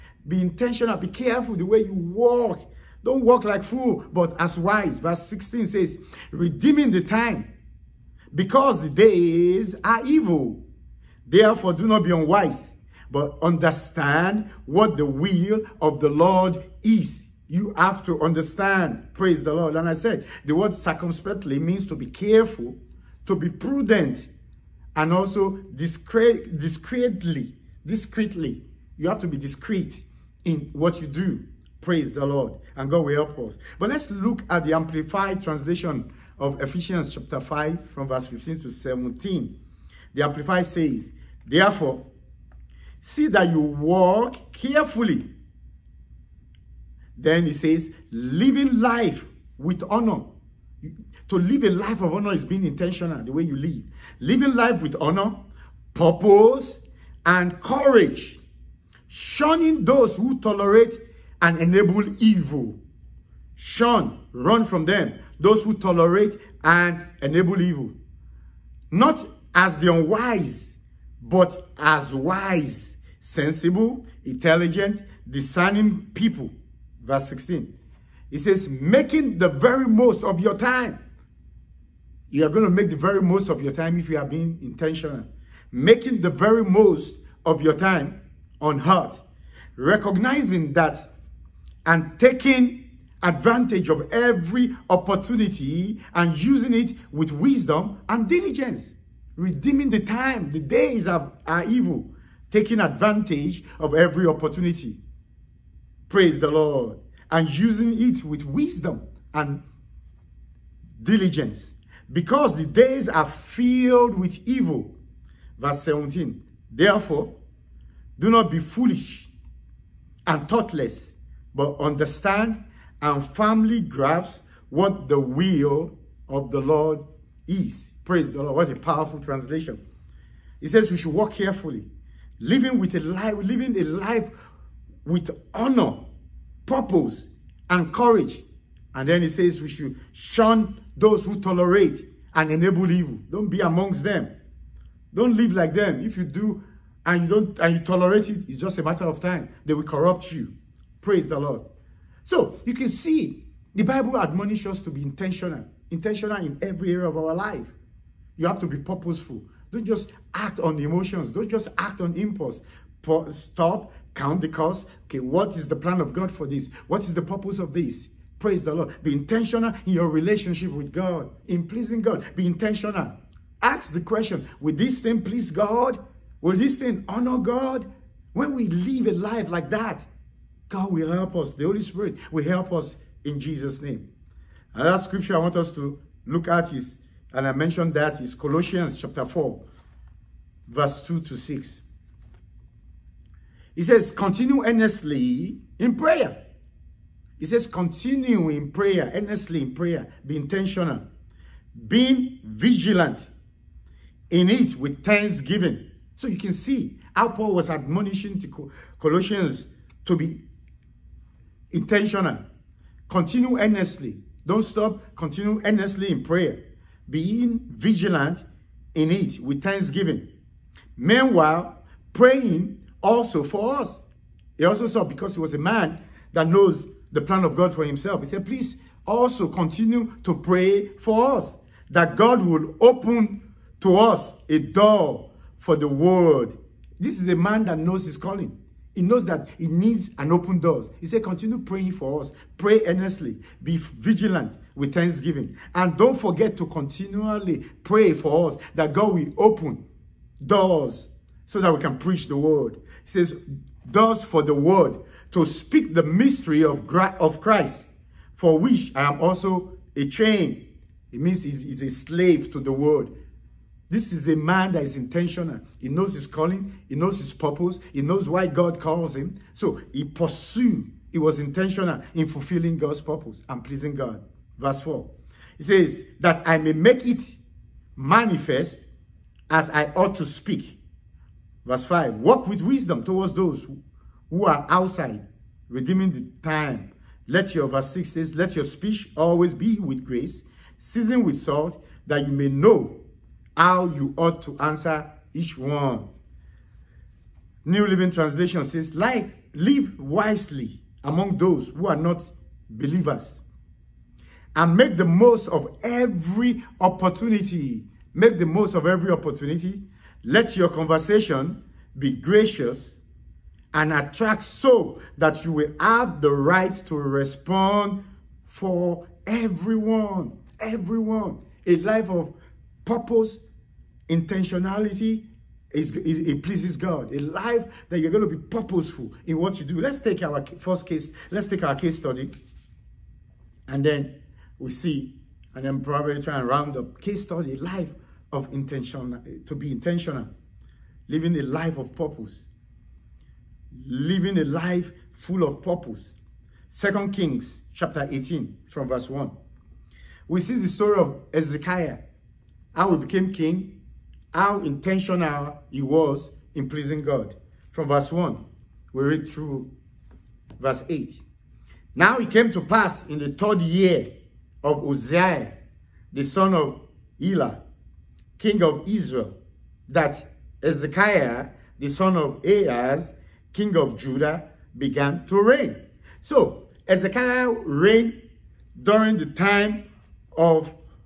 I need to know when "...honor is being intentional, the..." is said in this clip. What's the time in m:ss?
0:52.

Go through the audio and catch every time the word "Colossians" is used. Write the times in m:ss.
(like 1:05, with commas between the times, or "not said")
3:08, 3:28.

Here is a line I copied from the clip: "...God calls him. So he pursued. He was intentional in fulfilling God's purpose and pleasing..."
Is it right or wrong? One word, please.
right.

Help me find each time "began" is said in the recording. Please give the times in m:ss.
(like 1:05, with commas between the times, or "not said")
6:14.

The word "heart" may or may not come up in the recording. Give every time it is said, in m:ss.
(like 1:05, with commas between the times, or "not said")
1:28.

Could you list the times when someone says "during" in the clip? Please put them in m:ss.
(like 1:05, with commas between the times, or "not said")
6:18.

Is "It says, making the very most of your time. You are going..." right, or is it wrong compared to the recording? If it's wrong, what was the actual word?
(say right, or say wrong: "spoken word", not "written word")
right.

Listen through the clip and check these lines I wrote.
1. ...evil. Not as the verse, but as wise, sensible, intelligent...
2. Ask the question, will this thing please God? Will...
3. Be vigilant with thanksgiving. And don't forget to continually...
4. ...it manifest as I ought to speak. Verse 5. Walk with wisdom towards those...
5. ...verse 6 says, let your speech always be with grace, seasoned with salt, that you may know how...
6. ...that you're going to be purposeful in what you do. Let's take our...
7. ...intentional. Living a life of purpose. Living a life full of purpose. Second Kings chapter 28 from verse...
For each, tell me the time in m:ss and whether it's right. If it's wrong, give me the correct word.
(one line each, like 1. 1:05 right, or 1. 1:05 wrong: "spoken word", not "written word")
1. 1:07 wrong: "unwise", not "verse"
2. 2:53 right
3. 4:03 right
4. 4:37 right
5. 4:47 right
6. 5:27 right
7. 5:39 wrong: "18", not "28".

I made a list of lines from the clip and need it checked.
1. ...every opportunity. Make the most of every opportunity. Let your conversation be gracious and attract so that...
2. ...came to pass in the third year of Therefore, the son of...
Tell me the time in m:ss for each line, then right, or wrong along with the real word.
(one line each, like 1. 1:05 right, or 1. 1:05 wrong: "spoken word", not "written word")
1. 5:05 right
2. 6:02 wrong: "Uzziah", not "Therefore".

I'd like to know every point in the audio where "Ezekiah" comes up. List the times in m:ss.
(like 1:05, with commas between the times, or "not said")
5:51, 6:10, 6:16.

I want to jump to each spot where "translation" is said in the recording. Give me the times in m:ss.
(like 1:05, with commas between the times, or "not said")
0:35, 2:09, 4:58.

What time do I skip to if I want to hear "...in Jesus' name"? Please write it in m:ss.
3:03.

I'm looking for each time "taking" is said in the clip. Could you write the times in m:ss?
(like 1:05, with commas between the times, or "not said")
1:32, 1:42.